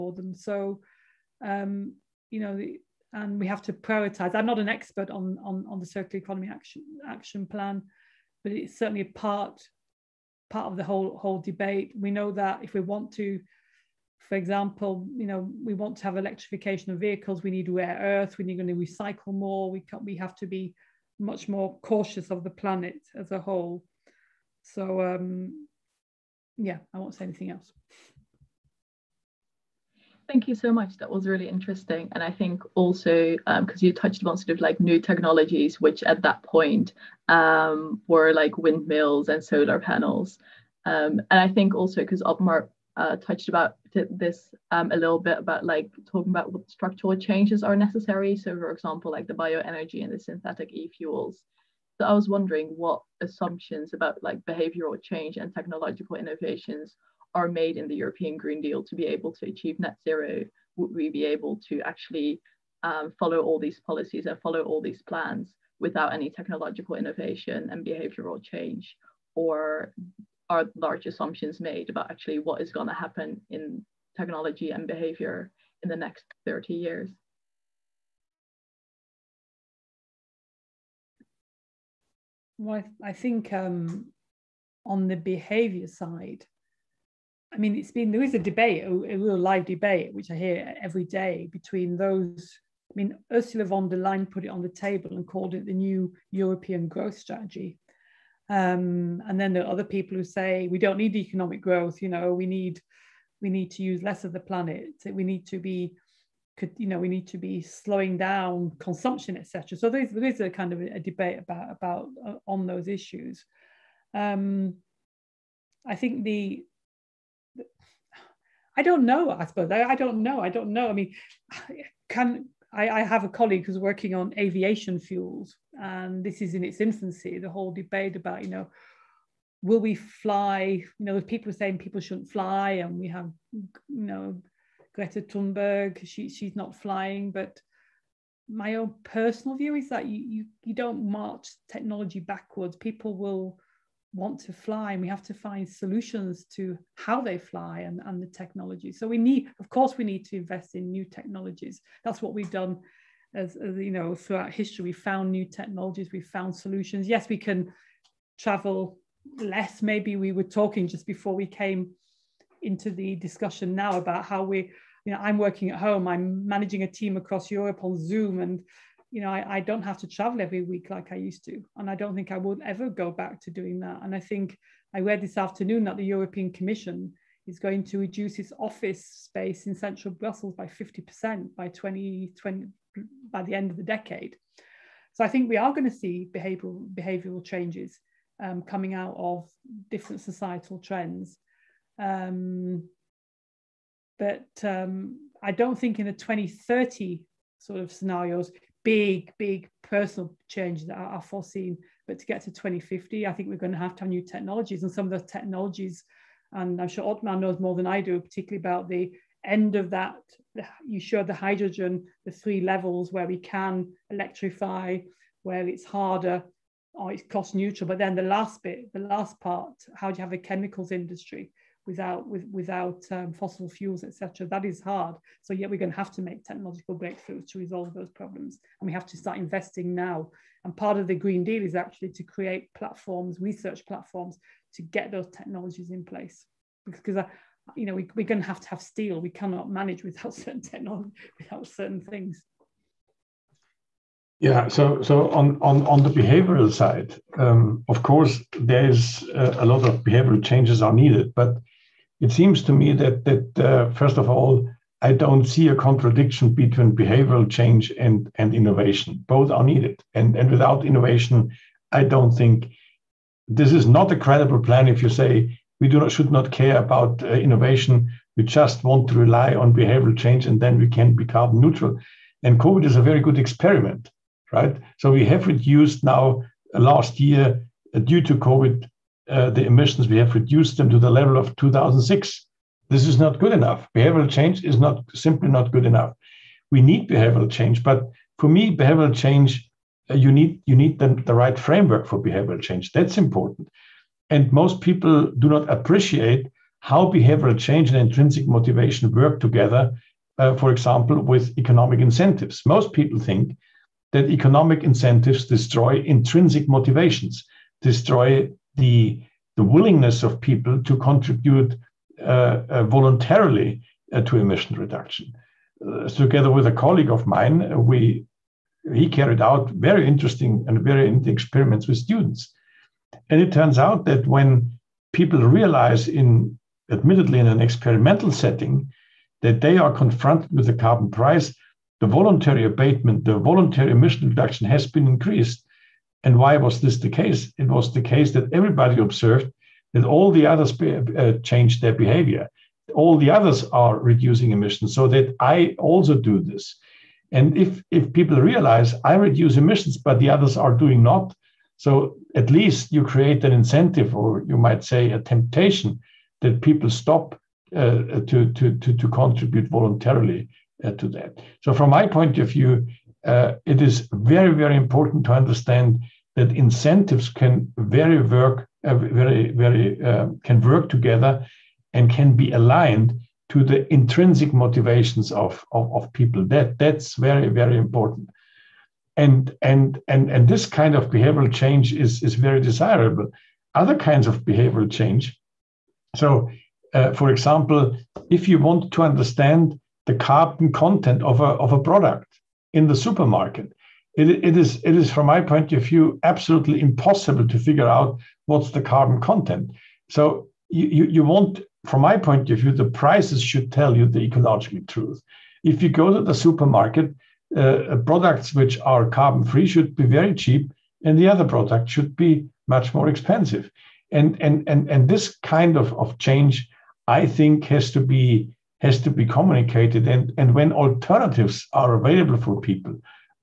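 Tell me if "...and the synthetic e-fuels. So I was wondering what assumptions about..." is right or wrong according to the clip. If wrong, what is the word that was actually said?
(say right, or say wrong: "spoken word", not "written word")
right.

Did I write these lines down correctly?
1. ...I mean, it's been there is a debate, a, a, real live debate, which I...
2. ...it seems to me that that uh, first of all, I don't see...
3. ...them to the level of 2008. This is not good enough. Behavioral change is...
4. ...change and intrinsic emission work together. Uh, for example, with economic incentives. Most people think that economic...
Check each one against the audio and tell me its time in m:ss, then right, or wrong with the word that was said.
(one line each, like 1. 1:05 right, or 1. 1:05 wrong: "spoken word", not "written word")
1. 1:27 right
2. 4:12 right
3. 4:40 wrong: "2006", not "2008"
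4. 4:57 wrong: "motivation", not "emission".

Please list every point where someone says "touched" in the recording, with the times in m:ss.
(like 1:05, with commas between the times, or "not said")
0:33, 0:43.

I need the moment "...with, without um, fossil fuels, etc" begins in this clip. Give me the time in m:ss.
3:42.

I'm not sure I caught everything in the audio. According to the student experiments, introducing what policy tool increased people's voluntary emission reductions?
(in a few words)
Carbon price.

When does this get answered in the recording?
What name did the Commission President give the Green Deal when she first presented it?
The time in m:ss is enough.
1:35.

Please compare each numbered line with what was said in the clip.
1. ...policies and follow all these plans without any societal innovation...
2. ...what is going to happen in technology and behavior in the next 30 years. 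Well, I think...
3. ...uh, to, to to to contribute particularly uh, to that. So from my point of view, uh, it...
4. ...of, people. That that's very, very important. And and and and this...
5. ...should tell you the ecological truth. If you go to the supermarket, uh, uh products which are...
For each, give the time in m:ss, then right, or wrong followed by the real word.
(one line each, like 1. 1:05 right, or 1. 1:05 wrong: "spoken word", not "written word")
1. 1:03 wrong: "technological", not "societal"
2. 1:12 right
3. 5:57 wrong: "voluntarily", not "particularly"
4. 6:15 right
5. 6:43 right.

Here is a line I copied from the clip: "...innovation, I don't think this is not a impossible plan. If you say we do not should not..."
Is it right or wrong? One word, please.
wrong.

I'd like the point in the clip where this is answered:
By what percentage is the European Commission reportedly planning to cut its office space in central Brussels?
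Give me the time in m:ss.
3:00.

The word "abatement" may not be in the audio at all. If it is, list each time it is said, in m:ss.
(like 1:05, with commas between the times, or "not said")
5:32.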